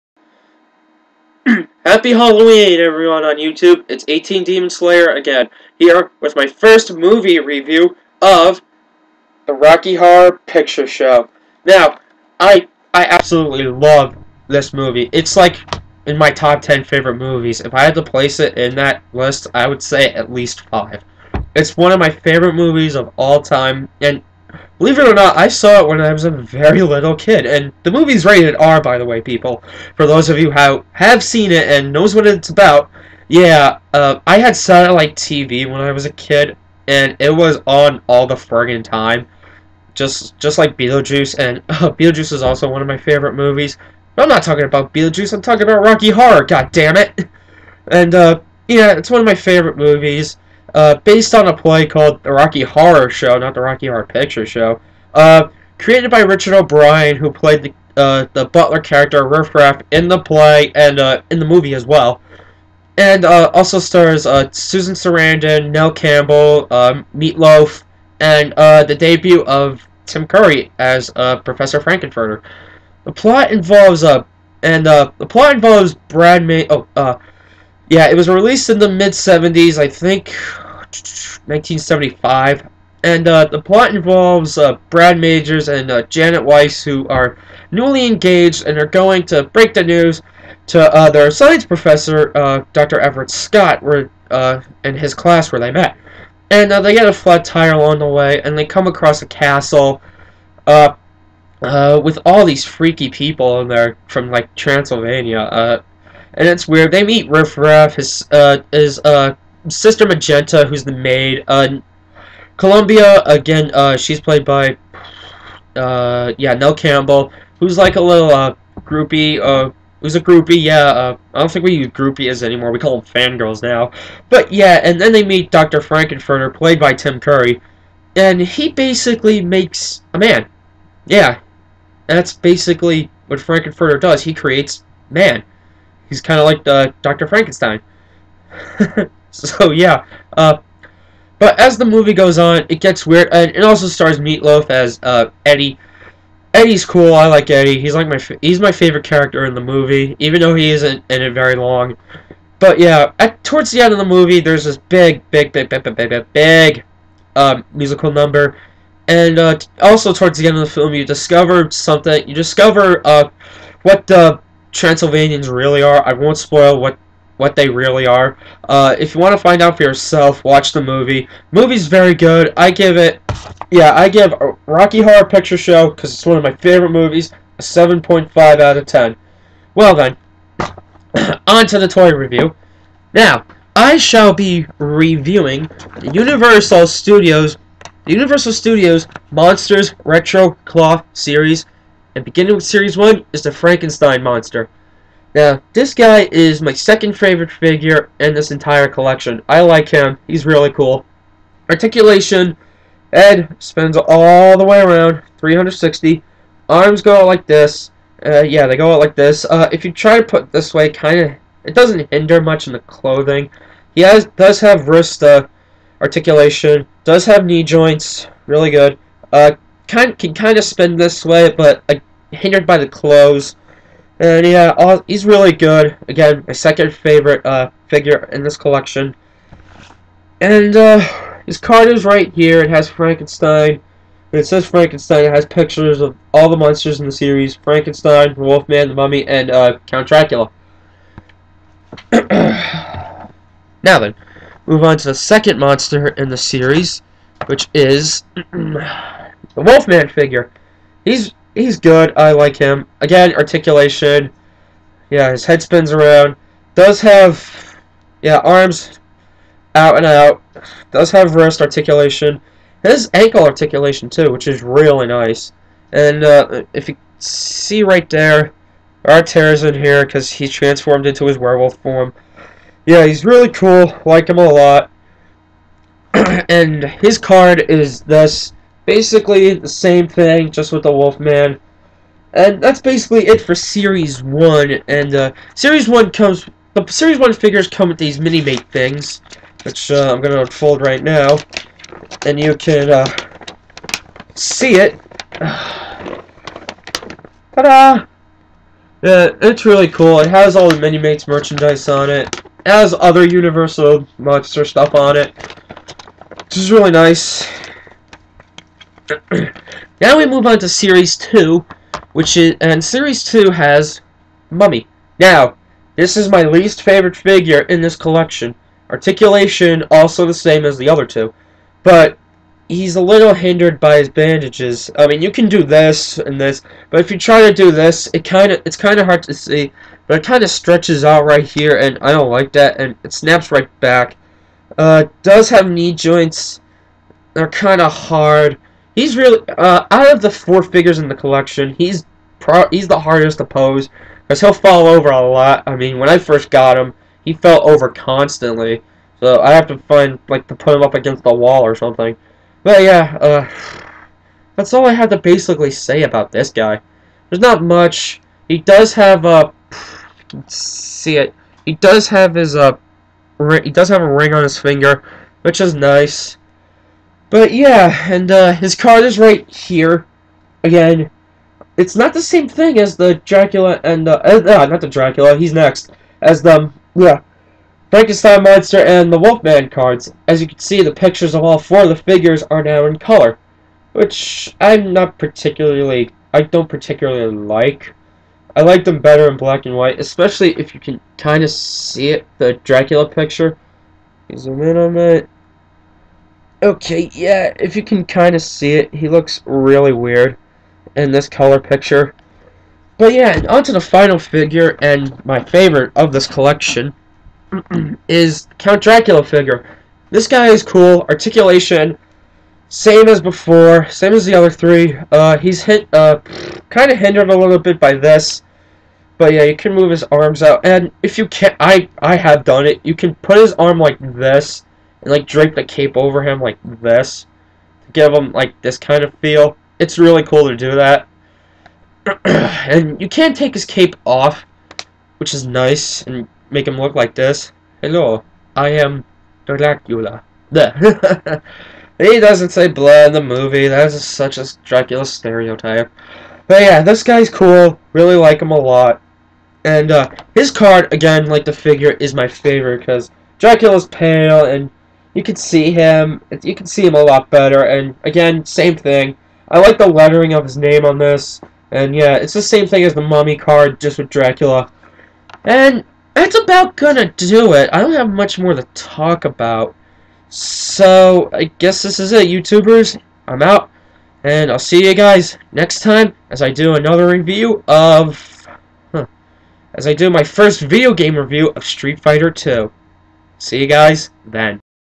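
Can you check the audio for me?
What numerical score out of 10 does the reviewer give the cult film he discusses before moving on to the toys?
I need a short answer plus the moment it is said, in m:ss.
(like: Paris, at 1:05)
7.5, at 2:57.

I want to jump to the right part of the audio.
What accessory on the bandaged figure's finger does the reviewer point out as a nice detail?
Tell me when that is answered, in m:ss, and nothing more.
6:04.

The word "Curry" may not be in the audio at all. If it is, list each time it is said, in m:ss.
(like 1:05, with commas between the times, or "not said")
1:10, 2:07.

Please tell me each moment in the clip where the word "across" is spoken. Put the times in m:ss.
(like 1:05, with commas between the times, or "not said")
1:38.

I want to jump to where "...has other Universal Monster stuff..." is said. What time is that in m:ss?
5:02.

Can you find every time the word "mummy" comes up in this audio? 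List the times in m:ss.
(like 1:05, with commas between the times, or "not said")
3:58, 5:14, 7:43.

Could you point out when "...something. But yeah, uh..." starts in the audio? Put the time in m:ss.
5:51.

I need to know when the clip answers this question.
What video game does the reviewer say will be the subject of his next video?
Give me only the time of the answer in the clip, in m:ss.
8:01.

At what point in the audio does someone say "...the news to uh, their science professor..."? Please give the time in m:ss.
1:29.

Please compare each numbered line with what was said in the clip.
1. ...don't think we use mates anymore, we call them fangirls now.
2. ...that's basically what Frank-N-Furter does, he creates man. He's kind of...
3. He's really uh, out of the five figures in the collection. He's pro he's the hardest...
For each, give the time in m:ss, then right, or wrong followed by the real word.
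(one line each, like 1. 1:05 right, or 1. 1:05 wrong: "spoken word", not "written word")
1. 2:01 wrong: "groupies", not "mates"
2. 2:12 right
3. 5:38 wrong: "four", not "five".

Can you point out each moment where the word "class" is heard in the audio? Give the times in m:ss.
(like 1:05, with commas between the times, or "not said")
1:35.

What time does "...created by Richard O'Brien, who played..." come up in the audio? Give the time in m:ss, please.
0:55.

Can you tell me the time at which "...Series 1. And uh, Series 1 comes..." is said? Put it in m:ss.
4:43.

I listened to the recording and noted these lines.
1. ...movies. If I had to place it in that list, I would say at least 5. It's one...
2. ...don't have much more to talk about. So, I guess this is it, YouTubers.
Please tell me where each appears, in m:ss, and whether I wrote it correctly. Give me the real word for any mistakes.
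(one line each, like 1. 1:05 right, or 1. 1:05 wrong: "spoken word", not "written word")
1. 0:17 right
2. 7:47 right.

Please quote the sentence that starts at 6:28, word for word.
I like them better in black and white, especially if you can kind of see it, the Dracula picture.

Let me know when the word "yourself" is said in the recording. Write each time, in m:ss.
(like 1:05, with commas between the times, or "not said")
2:49.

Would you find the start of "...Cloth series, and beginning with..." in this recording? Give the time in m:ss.
3:10.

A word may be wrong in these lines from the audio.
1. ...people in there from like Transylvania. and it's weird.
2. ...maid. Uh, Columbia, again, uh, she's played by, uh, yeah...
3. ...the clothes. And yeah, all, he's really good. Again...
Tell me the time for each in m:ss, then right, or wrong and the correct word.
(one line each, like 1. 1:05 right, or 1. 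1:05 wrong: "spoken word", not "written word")
1. 1:43 right
2. 1:50 right
3. 3:42 right.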